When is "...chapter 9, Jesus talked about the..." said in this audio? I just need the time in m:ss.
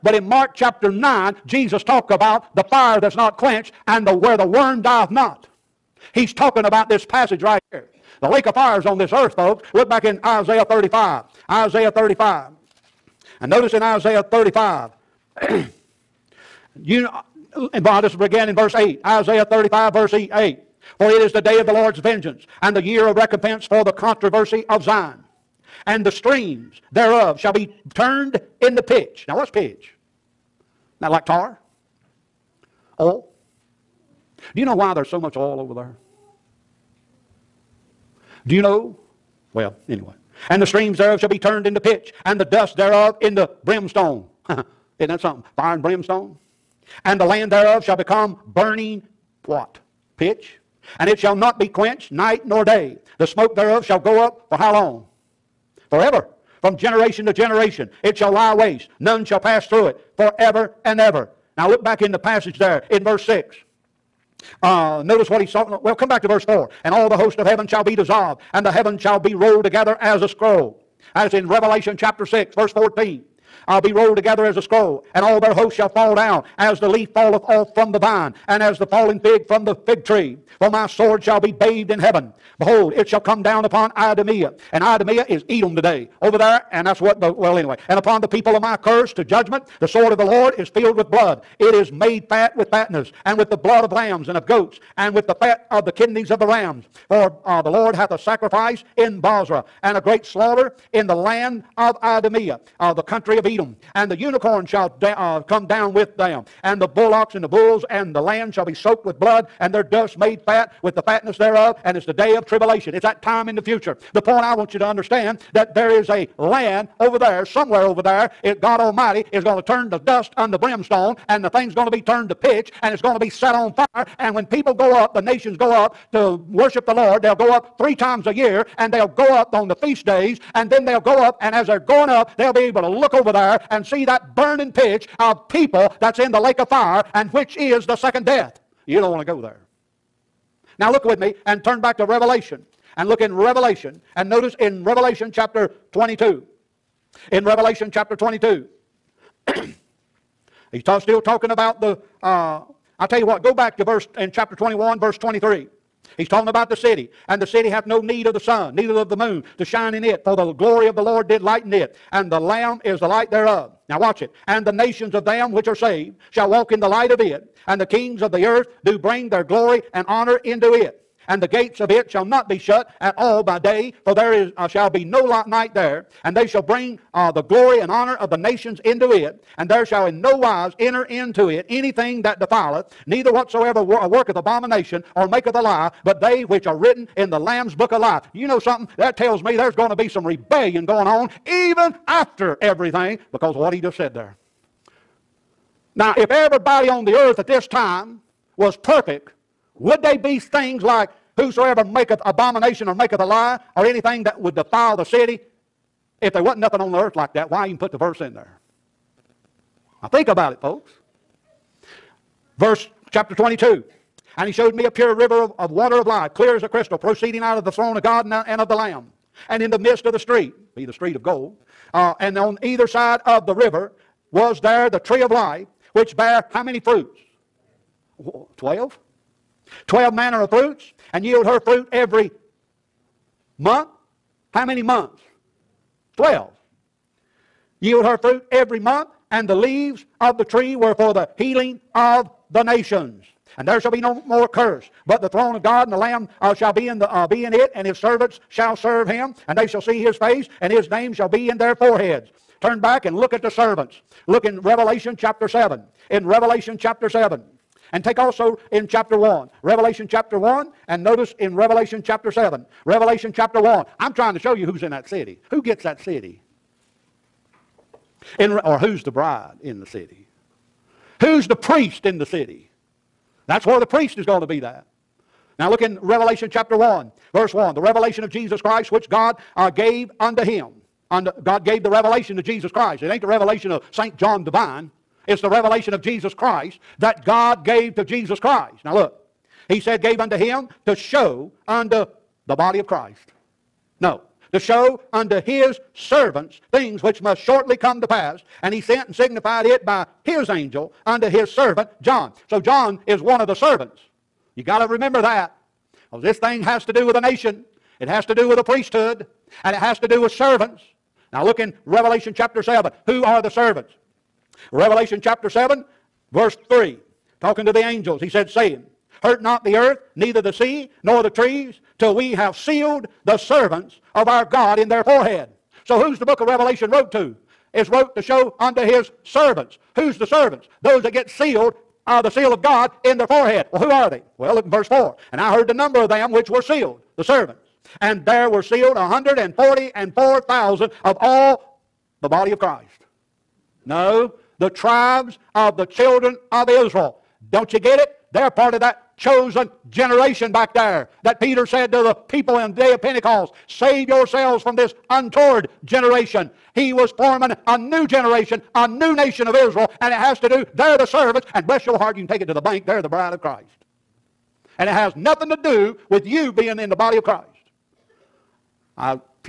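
0:00.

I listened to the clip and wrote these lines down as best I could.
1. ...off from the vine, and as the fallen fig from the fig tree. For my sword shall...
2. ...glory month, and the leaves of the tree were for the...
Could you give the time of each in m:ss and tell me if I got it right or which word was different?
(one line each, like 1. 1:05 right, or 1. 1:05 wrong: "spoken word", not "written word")
1. 1:17 right
2. 3:58 wrong: "every", not "glory".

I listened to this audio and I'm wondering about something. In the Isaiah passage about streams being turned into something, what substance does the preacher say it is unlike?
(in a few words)
Tar oil.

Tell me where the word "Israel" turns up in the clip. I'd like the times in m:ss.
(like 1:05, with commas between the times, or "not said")
5:46, 5:59.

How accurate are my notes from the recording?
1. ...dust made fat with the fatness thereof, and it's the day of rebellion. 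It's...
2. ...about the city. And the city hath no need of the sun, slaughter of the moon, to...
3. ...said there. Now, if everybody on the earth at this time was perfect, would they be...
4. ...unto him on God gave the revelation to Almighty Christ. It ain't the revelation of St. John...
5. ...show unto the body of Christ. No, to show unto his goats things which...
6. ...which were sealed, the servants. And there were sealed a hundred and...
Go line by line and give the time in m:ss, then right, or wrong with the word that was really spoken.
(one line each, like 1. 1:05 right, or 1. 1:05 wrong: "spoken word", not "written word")
1. 1:49 wrong: "tribulation", not "rebellion"
2. 2:36 wrong: "neither", not "slaughter"
3. 3:13 right
4. 4:40 wrong: "Jesus", not "Almighty"
5. 4:50 wrong: "servants", not "goats"
6. 5:36 right.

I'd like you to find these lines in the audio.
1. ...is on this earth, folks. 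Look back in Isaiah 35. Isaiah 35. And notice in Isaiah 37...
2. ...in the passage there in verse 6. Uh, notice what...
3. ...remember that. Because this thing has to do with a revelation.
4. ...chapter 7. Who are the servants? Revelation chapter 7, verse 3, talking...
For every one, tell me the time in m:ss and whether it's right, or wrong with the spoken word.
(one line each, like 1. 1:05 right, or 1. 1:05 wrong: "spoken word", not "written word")
1. 0:08 wrong: "35", not "37"
2. 1:02 right
3. 5:04 wrong: "nation", not "revelation"
4. 5:12 right.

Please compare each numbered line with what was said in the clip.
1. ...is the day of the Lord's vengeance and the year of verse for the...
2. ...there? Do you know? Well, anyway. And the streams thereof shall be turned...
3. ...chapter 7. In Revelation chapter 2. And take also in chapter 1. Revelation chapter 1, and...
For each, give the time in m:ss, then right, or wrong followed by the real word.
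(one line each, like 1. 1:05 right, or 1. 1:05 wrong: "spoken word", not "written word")
1. 0:21 wrong: "recompense", not "verse"
2. 0:35 right
3. 4:15 wrong: "7", not "2".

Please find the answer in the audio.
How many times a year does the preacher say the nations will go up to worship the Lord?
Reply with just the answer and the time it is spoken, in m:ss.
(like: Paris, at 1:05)
3, at 2:07.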